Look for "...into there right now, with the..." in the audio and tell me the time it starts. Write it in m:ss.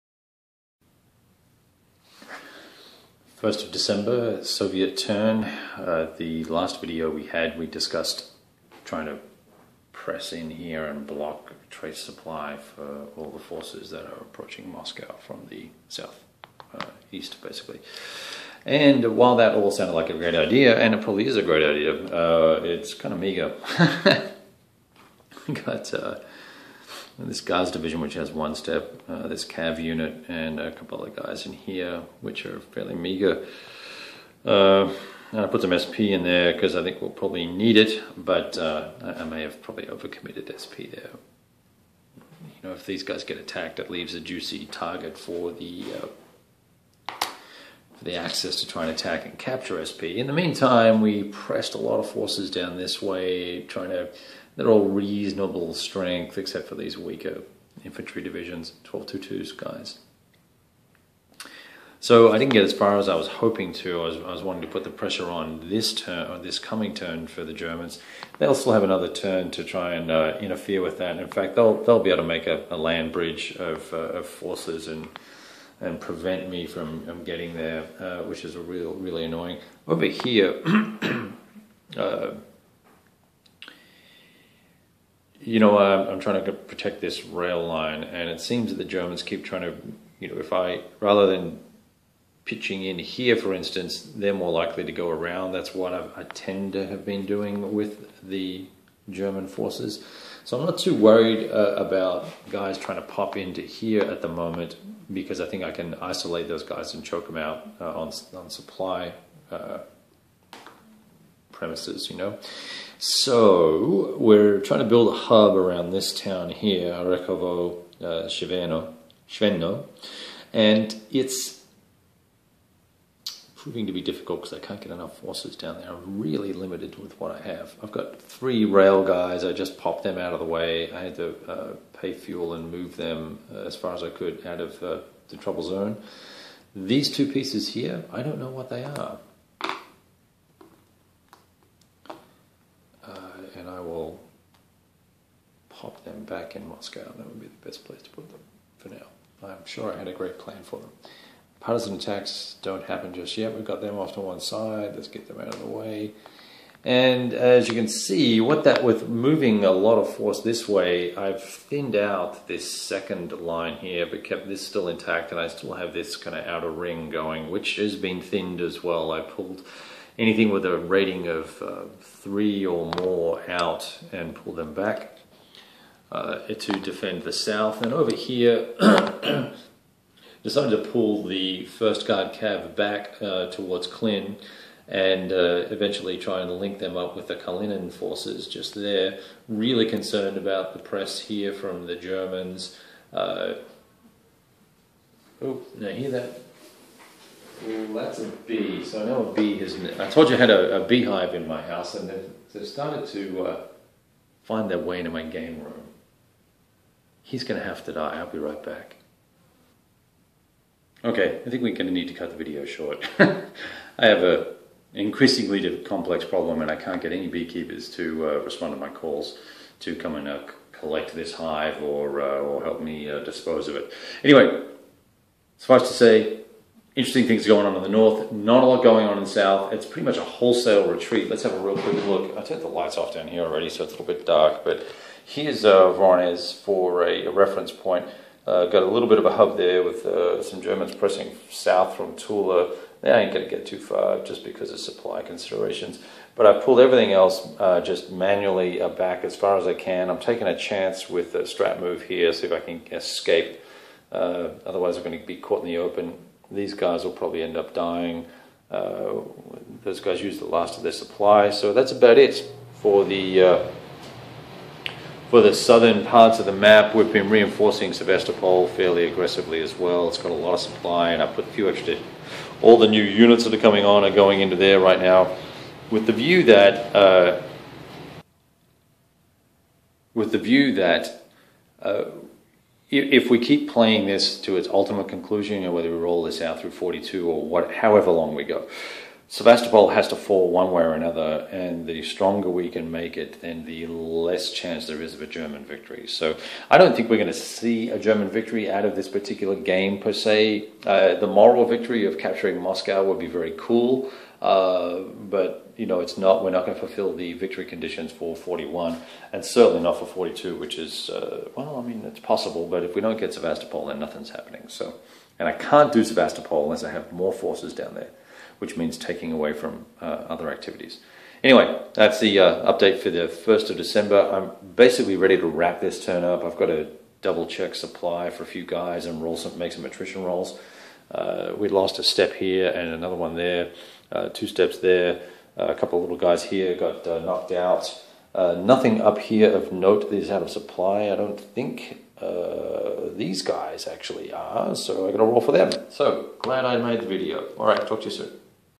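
4:34.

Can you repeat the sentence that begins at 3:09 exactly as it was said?
Really concerned about the press here from the Germans.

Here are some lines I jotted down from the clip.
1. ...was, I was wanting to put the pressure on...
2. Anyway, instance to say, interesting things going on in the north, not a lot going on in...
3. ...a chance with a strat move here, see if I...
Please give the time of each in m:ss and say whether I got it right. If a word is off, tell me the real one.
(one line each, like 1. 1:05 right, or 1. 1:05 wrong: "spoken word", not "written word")
1. 1:04 right
2. 3:44 wrong: "suffice", not "instance"
3. 4:10 right.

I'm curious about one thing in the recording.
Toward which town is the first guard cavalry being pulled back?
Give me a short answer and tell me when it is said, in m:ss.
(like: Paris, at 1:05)
Klin, at 3:03.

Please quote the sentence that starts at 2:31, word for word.
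Partisan attacks don't happen just yet.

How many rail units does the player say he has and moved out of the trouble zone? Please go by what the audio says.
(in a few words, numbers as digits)
3.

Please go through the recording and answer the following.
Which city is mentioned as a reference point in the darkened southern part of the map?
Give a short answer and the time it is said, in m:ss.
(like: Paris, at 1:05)
Voronezh, at 3:55.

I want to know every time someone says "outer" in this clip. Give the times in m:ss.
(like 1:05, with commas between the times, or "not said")
2:46.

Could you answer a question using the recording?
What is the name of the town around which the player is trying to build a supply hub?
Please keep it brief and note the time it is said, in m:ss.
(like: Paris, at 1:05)
Arekovo, at 1:56.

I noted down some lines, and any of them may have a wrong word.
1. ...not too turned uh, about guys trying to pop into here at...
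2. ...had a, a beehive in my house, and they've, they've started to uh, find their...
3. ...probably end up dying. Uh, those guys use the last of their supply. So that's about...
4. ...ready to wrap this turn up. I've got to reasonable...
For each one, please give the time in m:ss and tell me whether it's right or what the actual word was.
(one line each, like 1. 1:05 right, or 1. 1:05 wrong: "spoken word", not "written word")
1. 1:40 wrong: "worried", not "turned"
2. 3:20 right
3. 4:17 right
4. 5:25 wrong: "double", not "reasonable".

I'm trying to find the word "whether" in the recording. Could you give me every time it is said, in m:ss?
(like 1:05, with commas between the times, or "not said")
4:45.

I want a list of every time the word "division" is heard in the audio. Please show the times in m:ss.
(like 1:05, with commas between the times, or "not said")
0:27, 0:58.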